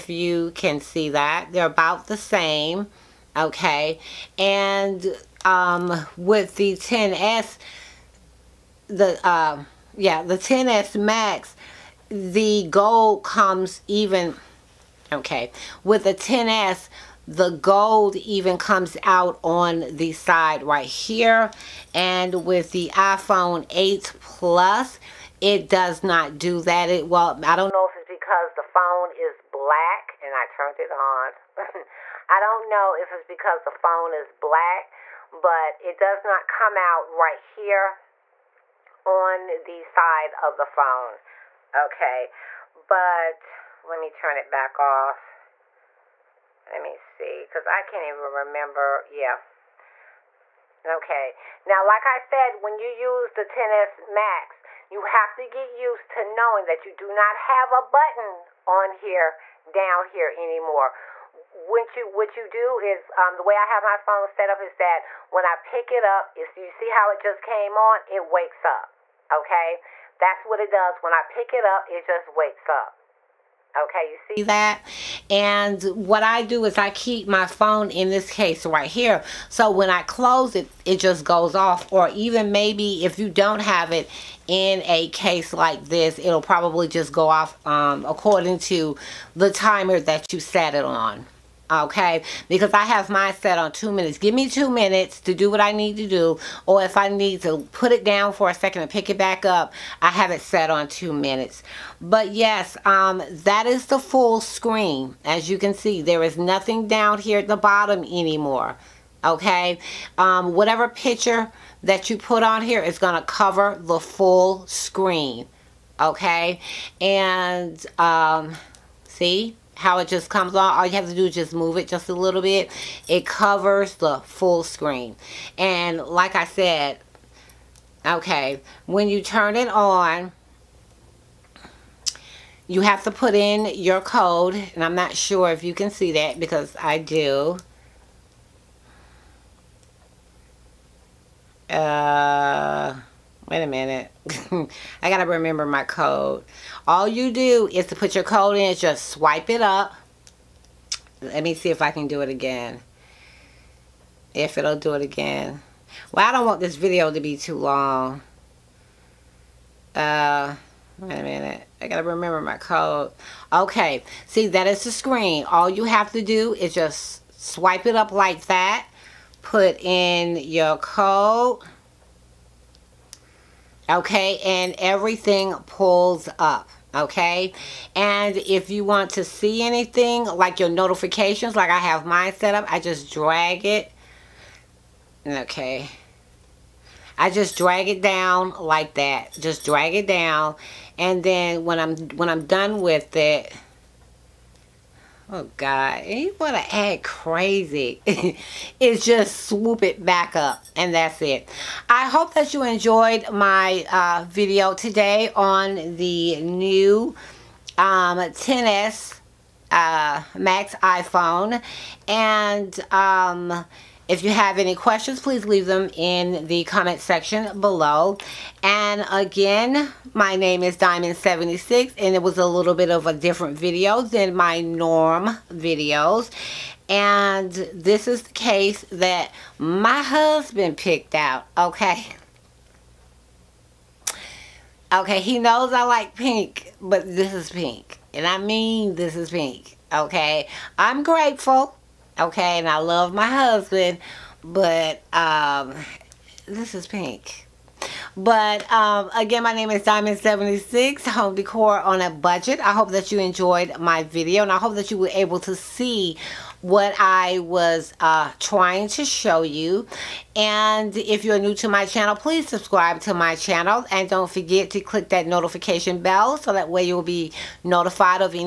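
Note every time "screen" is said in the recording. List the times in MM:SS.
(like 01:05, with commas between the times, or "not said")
01:44, 01:54, 02:04, 02:44.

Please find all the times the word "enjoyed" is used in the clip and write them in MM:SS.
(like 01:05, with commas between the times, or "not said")
03:22, 04:13.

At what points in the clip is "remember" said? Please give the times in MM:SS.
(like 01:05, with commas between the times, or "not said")
00:48, 02:25, 02:42.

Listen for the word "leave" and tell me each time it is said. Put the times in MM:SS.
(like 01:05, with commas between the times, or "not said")
03:35.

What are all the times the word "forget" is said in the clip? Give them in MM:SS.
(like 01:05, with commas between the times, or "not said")
04:24.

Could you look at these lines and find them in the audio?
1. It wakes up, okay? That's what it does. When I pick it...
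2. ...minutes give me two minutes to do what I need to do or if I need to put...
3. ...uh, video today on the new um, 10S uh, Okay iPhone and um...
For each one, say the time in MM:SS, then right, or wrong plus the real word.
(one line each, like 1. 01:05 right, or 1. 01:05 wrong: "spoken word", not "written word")
1. 01:08 right
2. 01:33 right
3. 03:23 wrong: "Max", not "Okay".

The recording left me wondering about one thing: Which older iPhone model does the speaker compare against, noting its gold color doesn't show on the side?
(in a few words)
iPhone 8 Plus.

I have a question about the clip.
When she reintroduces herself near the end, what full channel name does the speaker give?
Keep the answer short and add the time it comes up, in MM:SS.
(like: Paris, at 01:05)
Diamond76 Home Decor on a Budget, at 04:09.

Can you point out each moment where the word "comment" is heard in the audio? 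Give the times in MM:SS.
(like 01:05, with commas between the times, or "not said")
03:36.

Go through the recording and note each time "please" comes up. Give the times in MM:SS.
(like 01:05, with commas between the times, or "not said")
03:35, 04:22.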